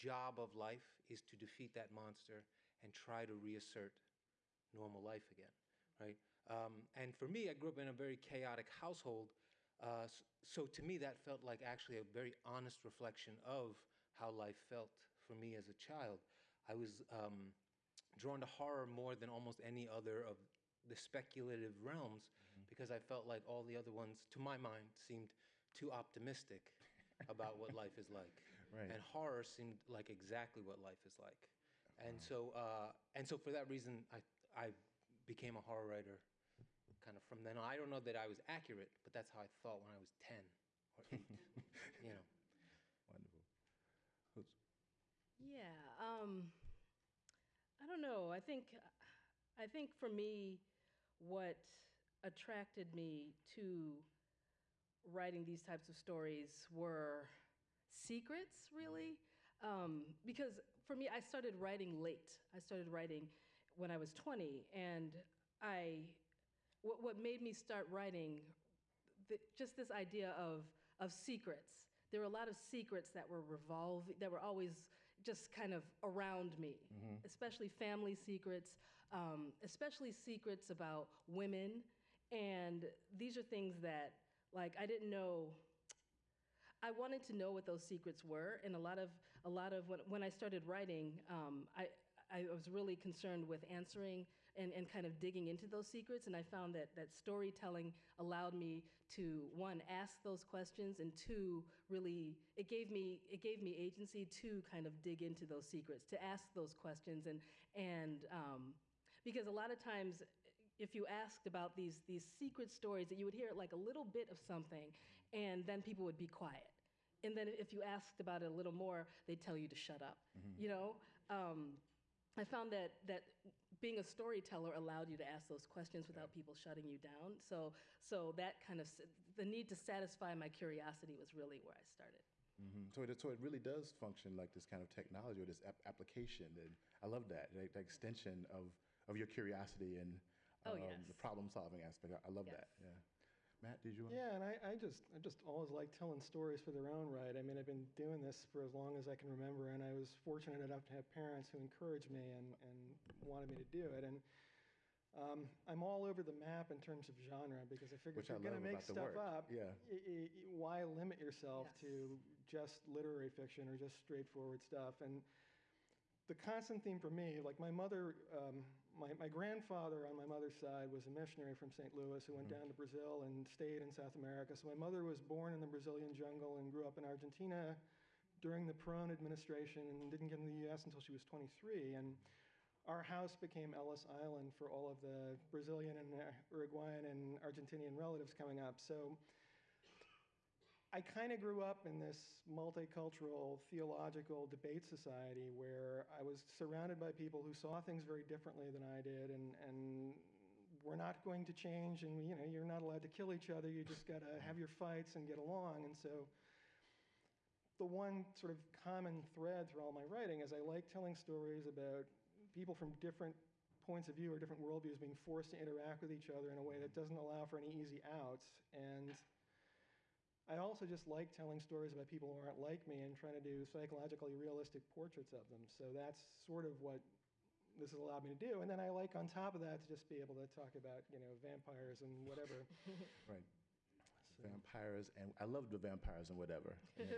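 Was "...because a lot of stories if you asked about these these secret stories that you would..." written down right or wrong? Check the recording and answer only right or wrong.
wrong.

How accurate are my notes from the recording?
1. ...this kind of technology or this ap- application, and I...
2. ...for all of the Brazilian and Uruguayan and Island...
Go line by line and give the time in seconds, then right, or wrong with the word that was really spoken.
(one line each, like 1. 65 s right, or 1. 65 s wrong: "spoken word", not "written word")
1. 134 s right
2. 184 s wrong: "Argentinian", not "Island".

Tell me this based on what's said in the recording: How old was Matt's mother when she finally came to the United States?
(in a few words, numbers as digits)
23.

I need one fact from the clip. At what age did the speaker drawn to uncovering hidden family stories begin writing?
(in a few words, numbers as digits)
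20.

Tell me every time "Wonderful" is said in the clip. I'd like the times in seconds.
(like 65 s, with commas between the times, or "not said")
43 s.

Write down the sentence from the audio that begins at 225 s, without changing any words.
So that's sort of what this has allowed me to do.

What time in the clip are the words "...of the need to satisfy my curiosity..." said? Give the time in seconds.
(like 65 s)
128 s.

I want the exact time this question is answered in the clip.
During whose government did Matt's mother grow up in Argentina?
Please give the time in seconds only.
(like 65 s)
178 s.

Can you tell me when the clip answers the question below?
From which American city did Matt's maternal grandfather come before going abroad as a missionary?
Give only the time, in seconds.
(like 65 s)
171 s.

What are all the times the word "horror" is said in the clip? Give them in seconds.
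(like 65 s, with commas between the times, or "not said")
18 s, 29 s, 35 s.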